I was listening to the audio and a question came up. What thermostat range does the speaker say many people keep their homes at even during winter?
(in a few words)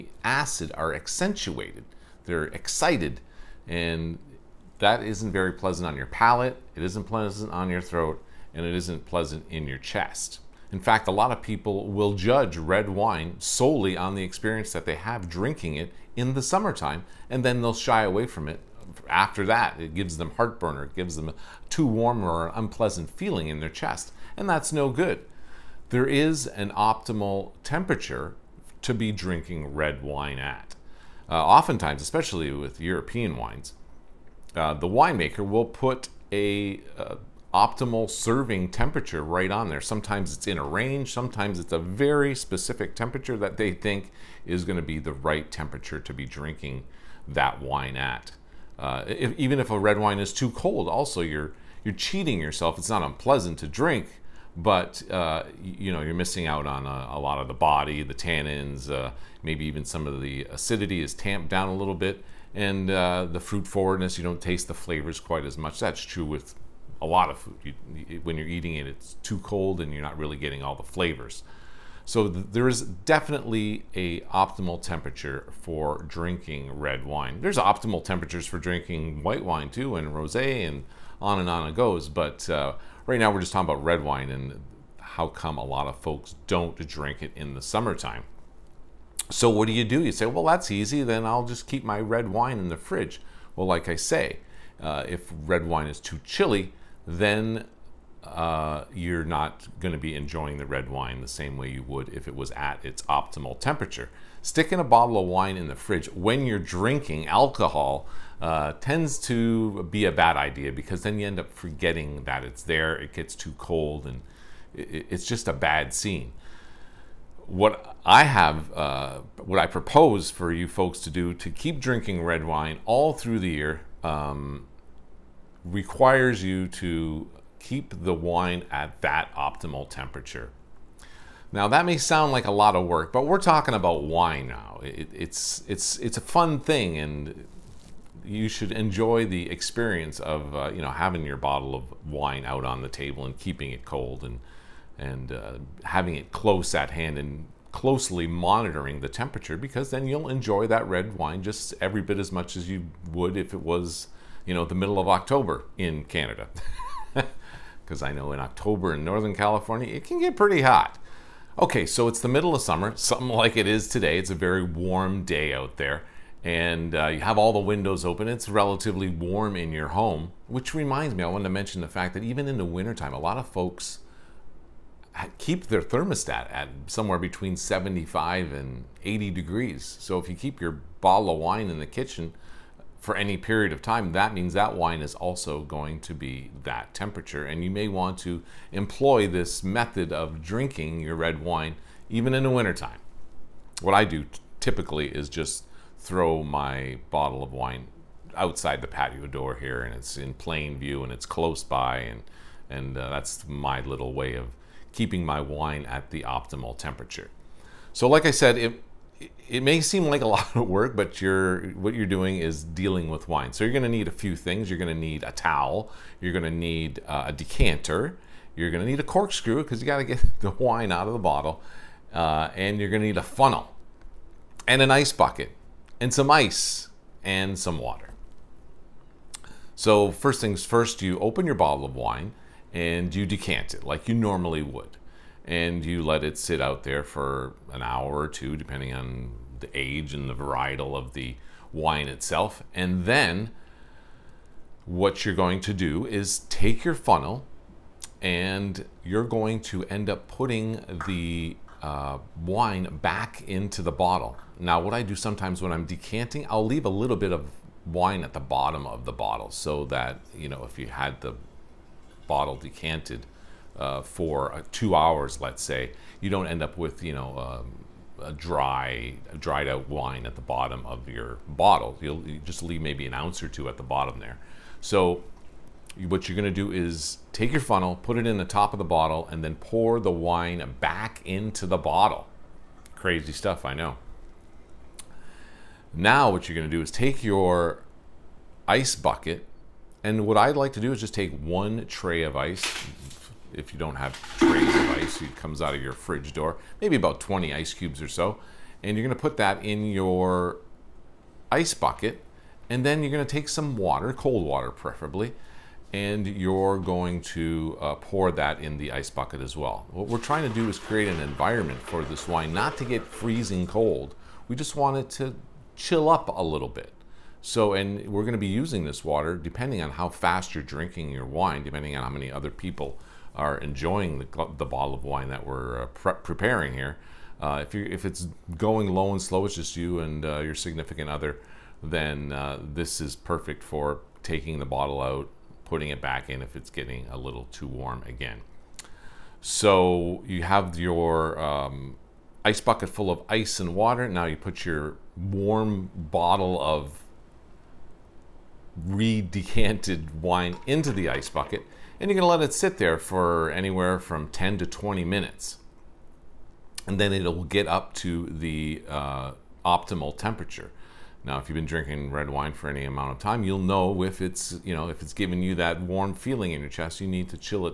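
75 to 80 degrees.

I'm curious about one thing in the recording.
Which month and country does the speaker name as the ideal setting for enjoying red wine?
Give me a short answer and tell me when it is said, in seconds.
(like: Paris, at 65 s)
October in Canada, at 155 s.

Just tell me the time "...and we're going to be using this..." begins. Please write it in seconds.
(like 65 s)
317 s.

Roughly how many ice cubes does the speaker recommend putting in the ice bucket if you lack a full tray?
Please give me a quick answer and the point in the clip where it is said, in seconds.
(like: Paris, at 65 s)
20, at 296 s.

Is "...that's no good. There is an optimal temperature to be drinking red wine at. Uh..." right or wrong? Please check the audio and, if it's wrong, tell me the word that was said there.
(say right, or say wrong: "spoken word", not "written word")
right.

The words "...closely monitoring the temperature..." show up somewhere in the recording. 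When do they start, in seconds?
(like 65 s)
147 s.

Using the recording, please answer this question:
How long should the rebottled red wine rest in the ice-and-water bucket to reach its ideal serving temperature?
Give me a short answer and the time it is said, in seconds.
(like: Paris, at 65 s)
10 to 20 minutes, at 354 s.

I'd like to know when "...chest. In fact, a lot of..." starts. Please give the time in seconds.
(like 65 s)
9 s.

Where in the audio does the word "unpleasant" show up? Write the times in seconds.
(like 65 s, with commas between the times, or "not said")
22 s, 53 s.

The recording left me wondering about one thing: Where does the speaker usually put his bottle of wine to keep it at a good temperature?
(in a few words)
Outside the patio door.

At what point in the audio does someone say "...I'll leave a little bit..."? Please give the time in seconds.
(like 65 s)
256 s.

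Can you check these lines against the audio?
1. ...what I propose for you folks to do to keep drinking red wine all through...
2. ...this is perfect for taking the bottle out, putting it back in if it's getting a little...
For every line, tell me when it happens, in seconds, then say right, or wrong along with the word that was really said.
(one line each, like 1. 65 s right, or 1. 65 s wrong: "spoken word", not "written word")
1. 119 s right
2. 332 s right.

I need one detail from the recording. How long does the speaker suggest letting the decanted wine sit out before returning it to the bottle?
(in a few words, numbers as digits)
1 or 2 hours.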